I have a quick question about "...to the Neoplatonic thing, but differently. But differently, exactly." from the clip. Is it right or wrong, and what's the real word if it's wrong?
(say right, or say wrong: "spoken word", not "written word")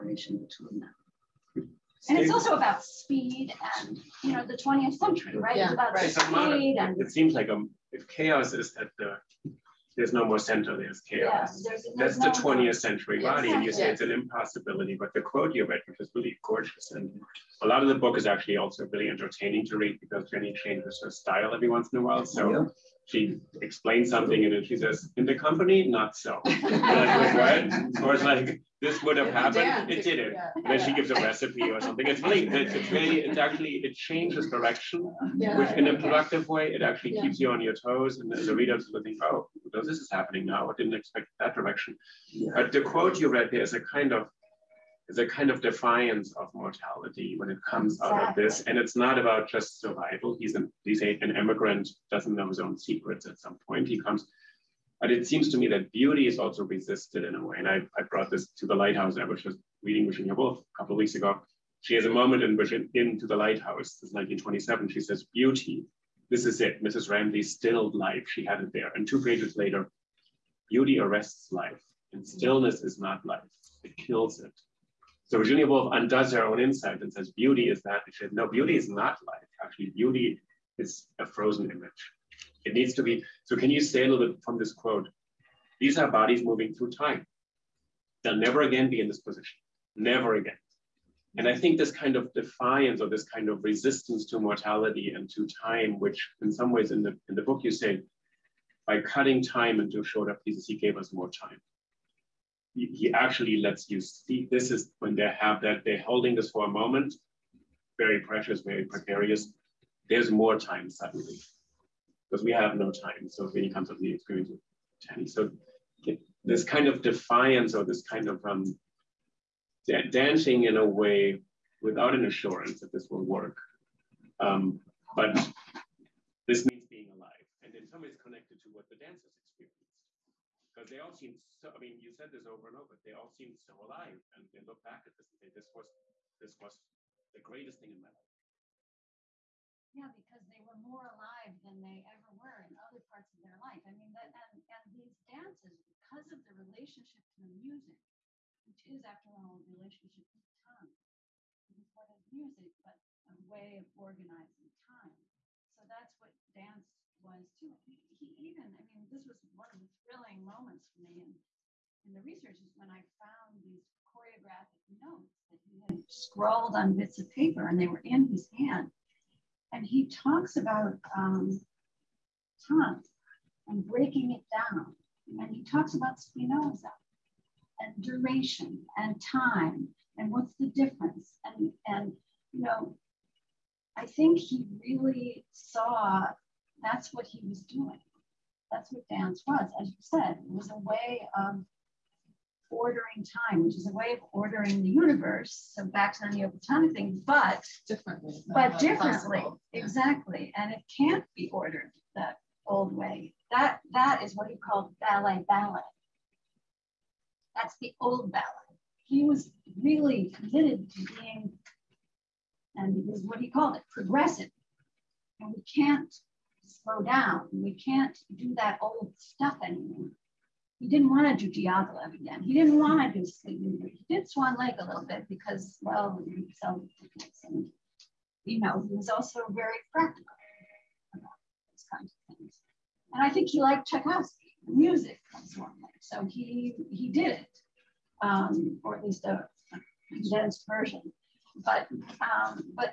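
right.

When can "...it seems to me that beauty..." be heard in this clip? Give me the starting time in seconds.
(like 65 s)
55 s.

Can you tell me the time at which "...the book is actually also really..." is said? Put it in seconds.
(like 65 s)
17 s.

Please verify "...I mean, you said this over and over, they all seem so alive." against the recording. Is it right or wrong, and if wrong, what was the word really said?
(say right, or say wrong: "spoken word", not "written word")
right.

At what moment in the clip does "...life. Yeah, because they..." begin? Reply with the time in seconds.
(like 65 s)
138 s.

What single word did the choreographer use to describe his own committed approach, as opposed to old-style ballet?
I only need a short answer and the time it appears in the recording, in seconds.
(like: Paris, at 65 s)
progressive, at 213 s.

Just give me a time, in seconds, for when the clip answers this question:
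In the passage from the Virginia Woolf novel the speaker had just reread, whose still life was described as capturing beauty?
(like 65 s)
66 s.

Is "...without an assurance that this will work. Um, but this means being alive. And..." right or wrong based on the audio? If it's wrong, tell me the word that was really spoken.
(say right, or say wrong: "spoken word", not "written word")
right.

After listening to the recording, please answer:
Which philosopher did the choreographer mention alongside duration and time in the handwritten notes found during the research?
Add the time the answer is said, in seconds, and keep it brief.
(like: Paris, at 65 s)
Spinoza, at 176 s.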